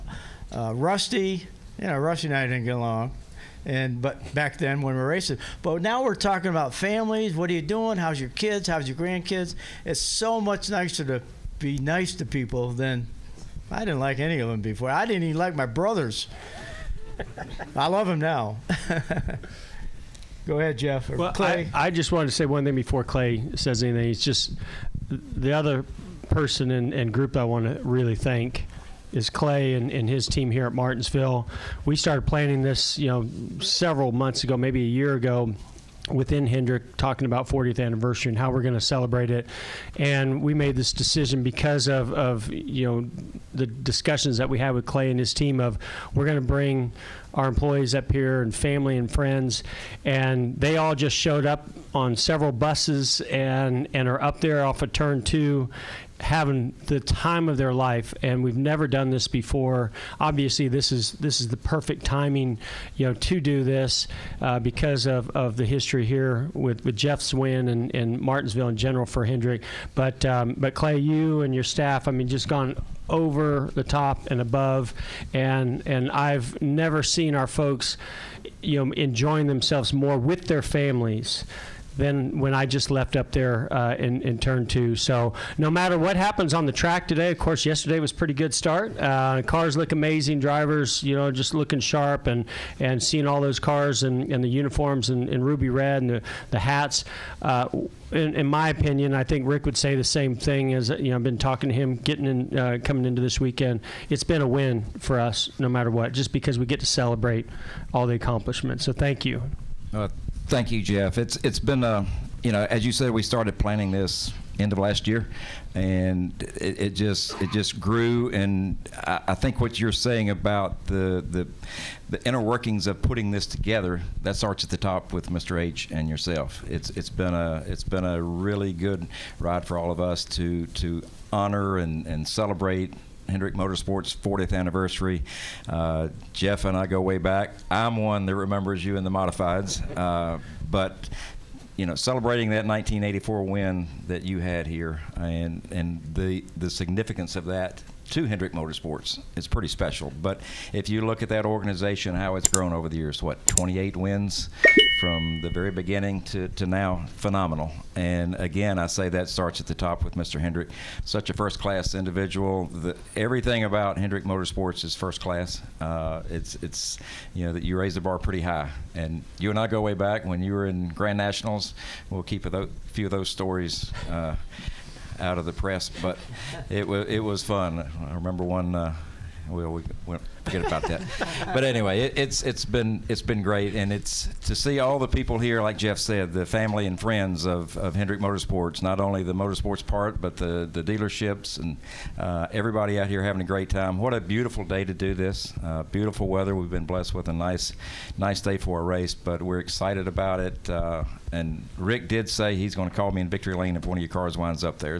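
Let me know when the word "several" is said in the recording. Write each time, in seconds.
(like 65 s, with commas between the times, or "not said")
33 s, 52 s.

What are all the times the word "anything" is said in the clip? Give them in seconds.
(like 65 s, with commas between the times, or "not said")
23 s.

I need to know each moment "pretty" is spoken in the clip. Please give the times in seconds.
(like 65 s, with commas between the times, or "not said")
88 s, 149 s, 168 s.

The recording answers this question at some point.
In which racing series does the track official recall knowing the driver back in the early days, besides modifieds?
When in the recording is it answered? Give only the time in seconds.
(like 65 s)
170 s.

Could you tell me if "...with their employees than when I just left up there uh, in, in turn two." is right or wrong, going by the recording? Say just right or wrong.
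wrong.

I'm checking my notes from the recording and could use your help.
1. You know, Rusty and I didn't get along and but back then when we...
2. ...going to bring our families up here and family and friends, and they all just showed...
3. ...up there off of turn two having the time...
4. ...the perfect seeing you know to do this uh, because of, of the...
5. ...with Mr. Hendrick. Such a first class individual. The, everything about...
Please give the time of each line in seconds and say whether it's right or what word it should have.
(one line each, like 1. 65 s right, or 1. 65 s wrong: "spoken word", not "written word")
1. 1 s right
2. 46 s wrong: "employees", not "families"
3. 54 s right
4. 61 s wrong: "timing", not "seeing"
5. 160 s right.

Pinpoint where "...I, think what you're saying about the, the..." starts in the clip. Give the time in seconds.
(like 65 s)
119 s.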